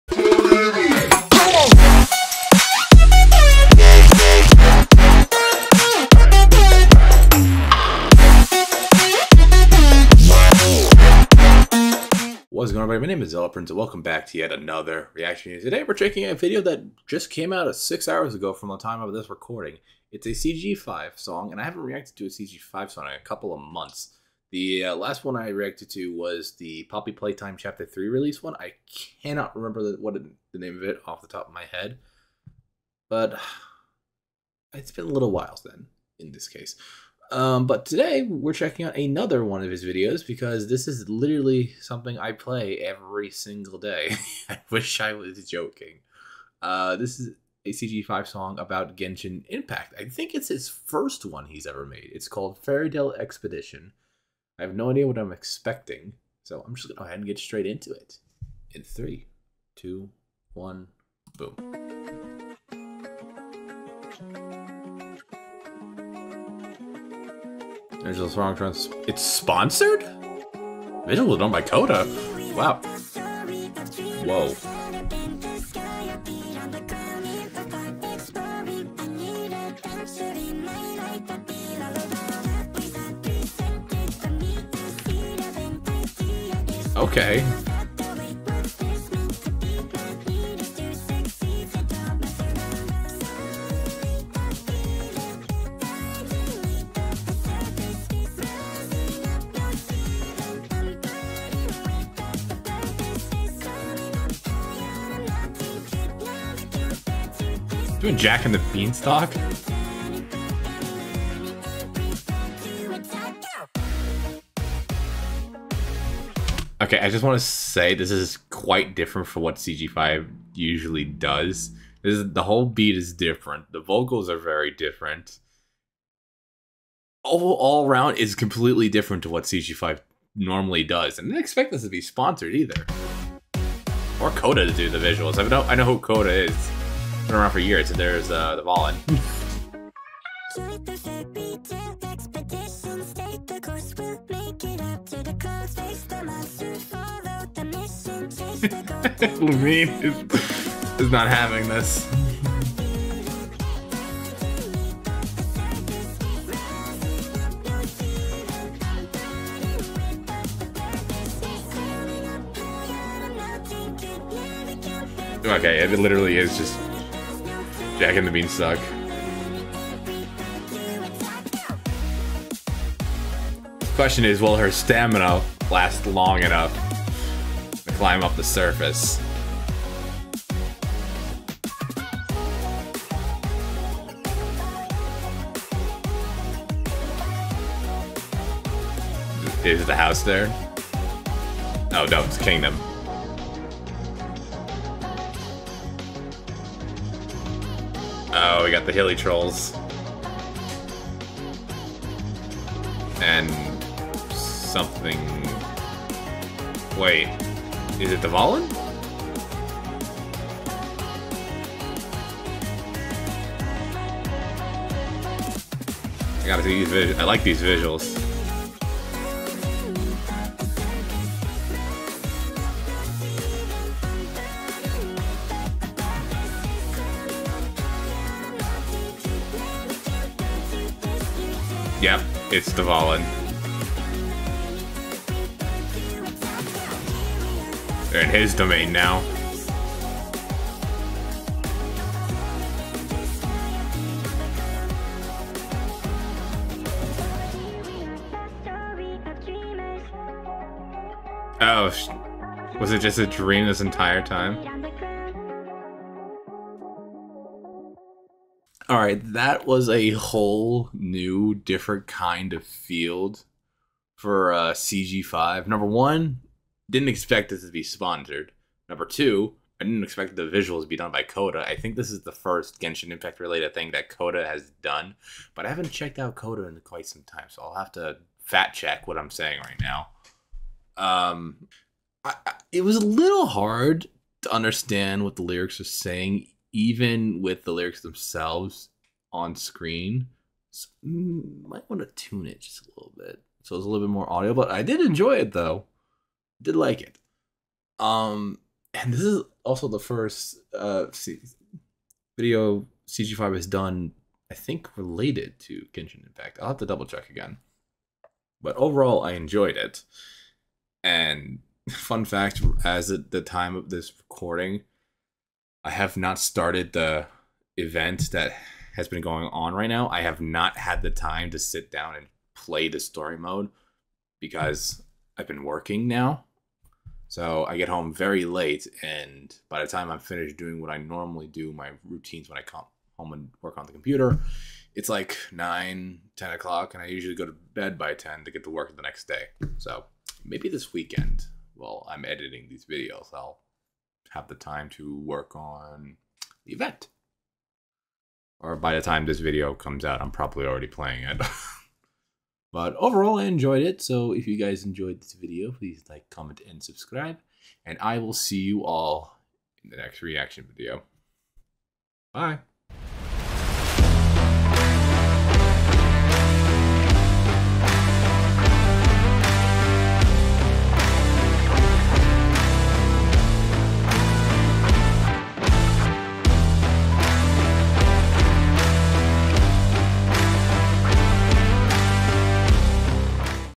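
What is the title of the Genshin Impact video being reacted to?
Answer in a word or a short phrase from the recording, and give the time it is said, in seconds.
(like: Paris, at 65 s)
Fairy Tale Expedition, at 52 s.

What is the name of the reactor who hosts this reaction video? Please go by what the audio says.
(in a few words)
Prince.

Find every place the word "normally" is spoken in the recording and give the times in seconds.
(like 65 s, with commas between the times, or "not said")
130 s, 330 s.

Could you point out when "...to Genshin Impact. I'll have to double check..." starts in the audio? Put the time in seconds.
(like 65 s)
305 s.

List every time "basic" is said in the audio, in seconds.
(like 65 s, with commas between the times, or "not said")
not said.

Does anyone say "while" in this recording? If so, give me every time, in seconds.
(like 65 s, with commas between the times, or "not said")
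35 s, 341 s.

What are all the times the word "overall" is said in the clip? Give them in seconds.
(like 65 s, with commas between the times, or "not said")
308 s, 352 s.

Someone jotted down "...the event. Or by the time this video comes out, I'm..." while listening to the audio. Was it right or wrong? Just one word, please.
right.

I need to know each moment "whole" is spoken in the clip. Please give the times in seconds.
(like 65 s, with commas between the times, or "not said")
122 s, 260 s.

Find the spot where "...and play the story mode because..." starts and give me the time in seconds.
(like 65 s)
322 s.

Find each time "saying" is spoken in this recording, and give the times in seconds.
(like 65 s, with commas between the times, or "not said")
279 s, 285 s.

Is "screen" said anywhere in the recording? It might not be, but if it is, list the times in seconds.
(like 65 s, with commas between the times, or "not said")
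289 s.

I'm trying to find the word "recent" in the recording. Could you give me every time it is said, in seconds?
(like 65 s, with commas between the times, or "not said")
not said.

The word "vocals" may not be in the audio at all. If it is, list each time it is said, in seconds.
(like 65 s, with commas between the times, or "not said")
123 s.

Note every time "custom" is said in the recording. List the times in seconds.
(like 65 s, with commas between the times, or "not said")
not said.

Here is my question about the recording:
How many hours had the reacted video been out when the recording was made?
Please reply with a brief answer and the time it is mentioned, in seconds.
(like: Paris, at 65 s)
6, at 17 s.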